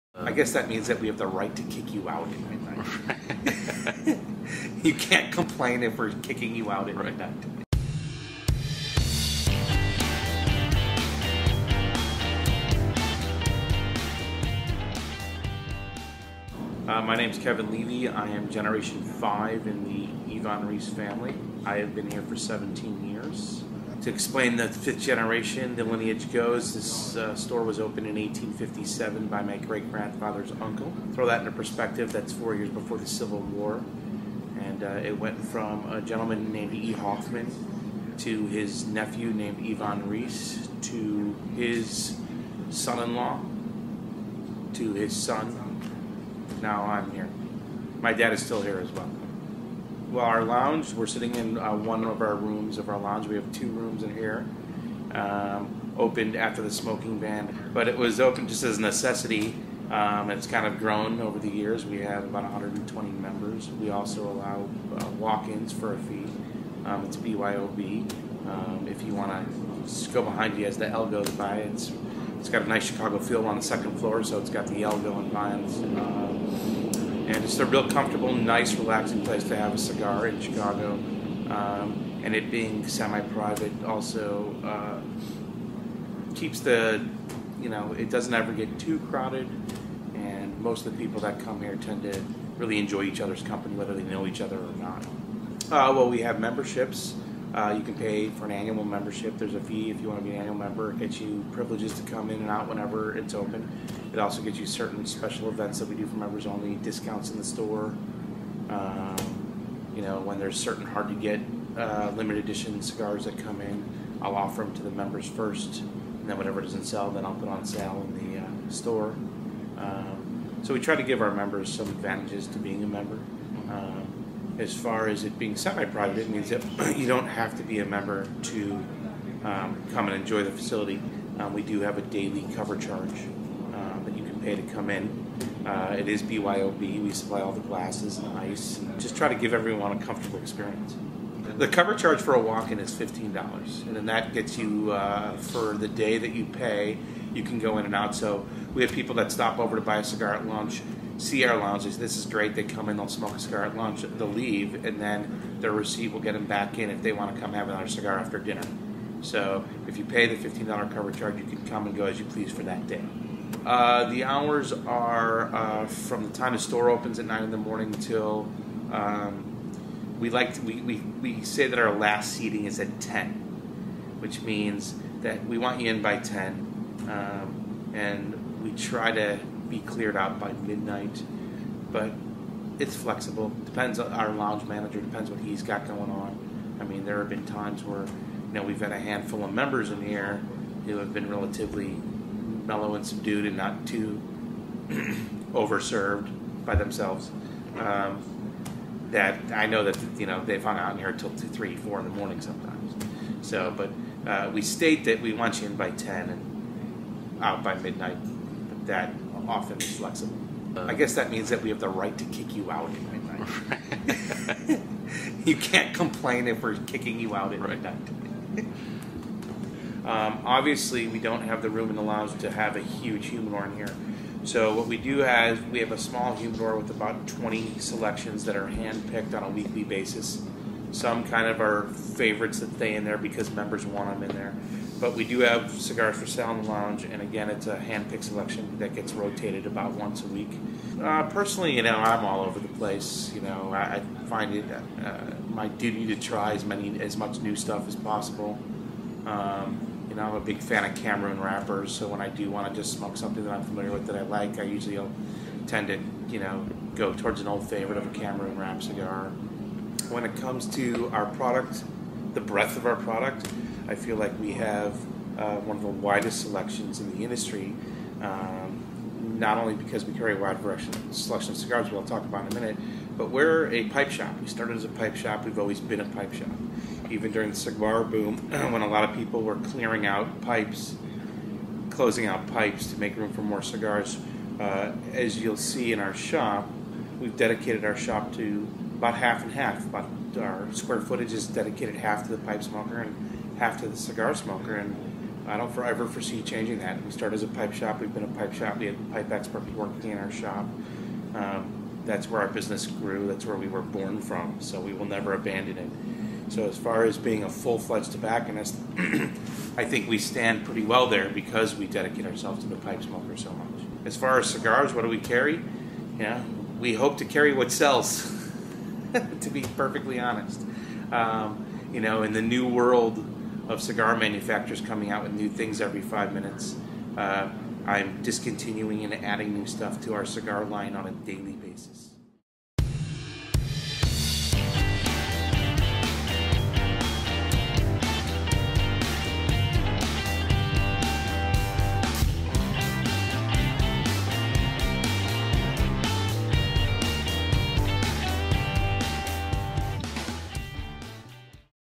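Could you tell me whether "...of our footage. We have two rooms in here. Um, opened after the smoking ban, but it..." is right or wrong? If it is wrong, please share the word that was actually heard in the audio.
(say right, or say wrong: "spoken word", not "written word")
wrong: "lounge", not "footage".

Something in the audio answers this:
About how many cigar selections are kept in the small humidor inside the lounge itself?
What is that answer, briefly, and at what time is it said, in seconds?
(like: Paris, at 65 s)
20, at 227 s.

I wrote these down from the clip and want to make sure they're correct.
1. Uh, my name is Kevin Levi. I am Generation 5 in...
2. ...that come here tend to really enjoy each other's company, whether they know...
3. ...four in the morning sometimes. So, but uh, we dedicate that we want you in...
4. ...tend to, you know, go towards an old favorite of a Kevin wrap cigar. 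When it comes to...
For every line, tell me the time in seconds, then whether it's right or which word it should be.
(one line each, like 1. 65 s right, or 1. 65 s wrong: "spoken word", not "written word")
1. 16 s right
2. 91 s right
3. 201 s wrong: "state", not "dedicate"
4. 255 s wrong: "Cameroon", not "Kevin".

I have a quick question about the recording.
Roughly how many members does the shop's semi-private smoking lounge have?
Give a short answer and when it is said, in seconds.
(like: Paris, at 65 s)
120, at 62 s.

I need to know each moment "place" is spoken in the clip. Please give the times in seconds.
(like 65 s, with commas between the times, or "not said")
79 s, 242 s.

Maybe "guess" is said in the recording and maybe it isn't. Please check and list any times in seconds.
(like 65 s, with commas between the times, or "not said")
0 s, 210 s.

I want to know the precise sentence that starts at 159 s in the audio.
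So if you pay the $15 cover charge, you can come and go as you please for that day.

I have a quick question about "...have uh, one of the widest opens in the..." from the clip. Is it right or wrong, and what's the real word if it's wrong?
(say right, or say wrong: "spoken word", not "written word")
wrong: "selections", not "opens".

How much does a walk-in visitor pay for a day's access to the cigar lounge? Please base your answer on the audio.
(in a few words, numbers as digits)
$15.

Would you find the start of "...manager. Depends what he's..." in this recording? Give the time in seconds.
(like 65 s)
184 s.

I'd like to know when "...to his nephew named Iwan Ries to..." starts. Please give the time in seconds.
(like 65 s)
38 s.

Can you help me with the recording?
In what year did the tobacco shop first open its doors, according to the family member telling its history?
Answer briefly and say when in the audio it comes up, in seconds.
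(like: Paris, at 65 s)
1857, at 28 s.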